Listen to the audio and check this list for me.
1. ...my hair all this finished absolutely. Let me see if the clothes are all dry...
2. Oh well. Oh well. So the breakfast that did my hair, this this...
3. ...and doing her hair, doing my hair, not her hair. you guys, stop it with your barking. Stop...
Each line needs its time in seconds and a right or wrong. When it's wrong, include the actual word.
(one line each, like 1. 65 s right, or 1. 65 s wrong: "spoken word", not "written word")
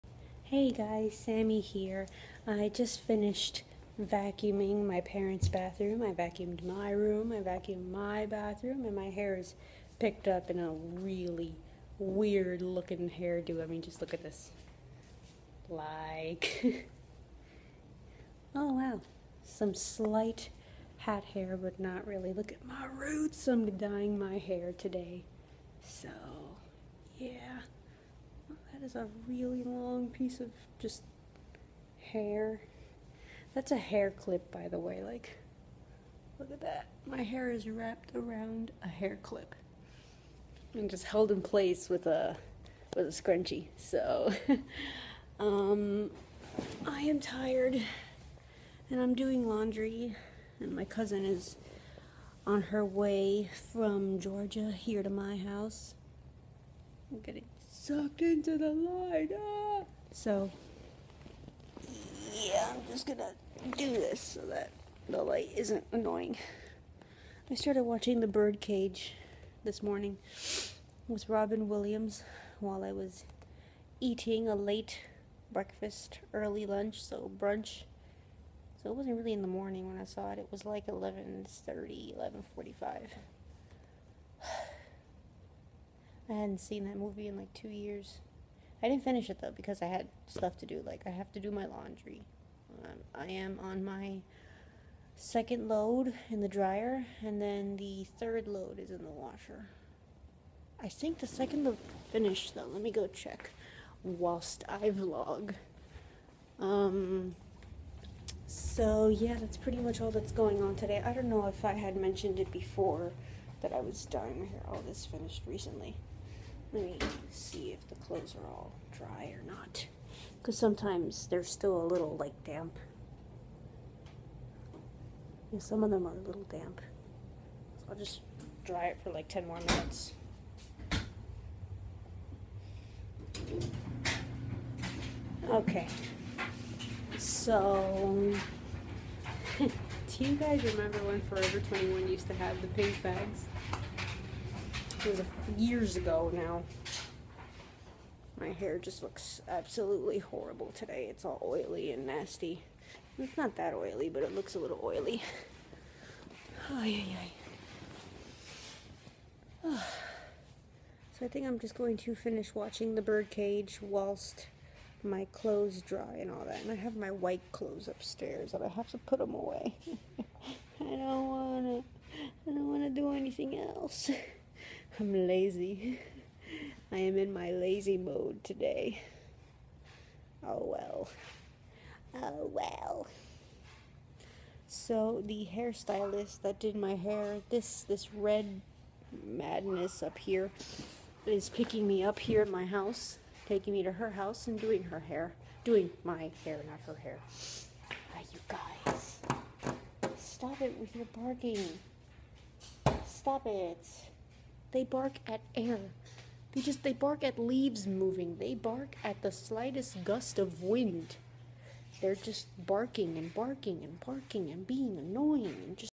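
1. 114 s wrong: "recently", not "absolutely"
2. 180 s wrong: "hairstylist", not "breakfast"
3. 194 s right.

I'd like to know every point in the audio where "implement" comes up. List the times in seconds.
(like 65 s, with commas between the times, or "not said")
not said.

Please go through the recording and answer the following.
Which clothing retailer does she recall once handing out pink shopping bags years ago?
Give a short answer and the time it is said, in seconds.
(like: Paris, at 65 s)
Forever 21, at 141 s.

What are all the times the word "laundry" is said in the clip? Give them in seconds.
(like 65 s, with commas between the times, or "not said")
49 s, 91 s.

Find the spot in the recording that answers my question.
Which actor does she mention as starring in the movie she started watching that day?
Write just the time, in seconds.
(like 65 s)
71 s.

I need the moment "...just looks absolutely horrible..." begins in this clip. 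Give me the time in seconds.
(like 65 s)
148 s.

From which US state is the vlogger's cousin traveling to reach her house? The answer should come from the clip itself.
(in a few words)
Georgia.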